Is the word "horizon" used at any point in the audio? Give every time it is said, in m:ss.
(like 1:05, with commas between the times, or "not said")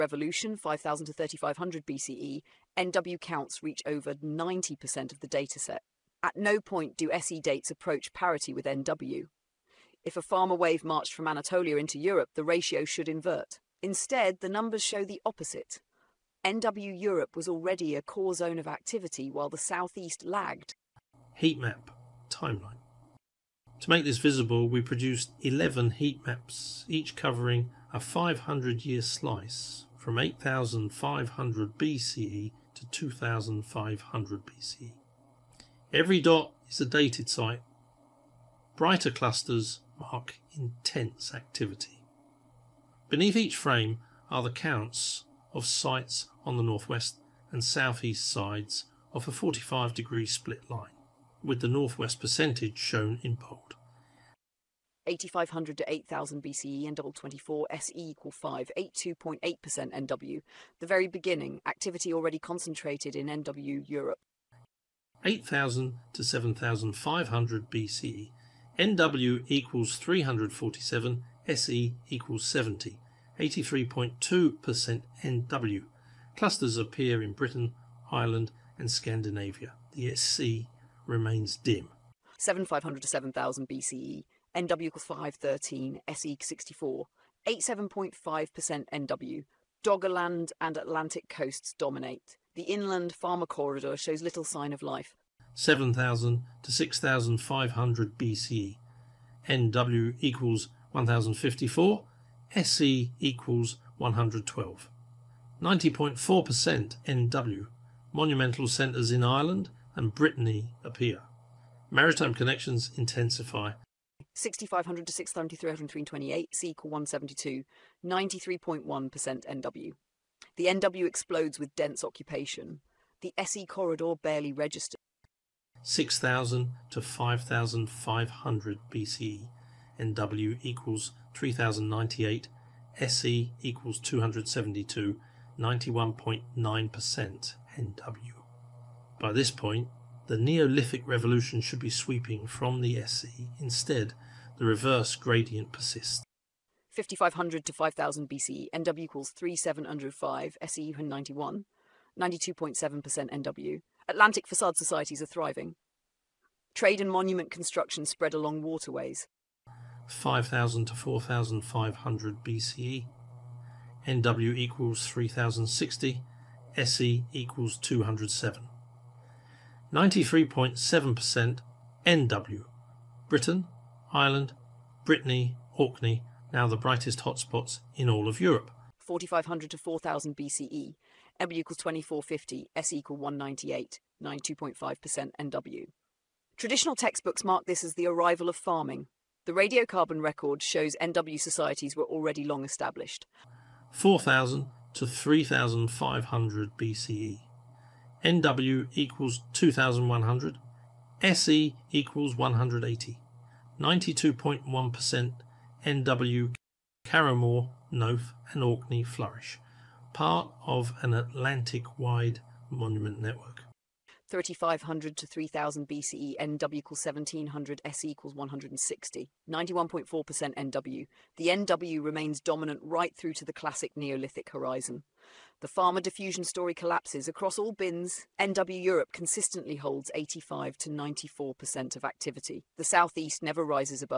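3:44.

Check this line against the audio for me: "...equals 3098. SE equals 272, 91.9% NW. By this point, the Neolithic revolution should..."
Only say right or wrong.
right.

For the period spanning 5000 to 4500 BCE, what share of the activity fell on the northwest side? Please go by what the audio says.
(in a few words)
93.7%.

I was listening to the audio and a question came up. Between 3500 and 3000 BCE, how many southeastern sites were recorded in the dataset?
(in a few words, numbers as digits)
160.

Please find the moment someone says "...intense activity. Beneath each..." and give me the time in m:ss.
0:40.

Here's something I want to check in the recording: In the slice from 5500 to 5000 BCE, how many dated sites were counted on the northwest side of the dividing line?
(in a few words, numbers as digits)
3705.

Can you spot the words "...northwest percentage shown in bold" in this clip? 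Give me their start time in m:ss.
0:51.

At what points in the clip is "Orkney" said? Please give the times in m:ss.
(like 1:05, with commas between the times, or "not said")
2:55, 3:28.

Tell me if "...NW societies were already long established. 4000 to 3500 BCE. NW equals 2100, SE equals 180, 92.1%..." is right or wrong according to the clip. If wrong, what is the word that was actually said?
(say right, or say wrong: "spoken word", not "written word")
right.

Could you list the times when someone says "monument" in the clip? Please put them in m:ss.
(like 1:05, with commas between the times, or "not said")
2:37, 3:32.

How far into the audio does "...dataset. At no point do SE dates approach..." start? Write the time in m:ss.
0:05.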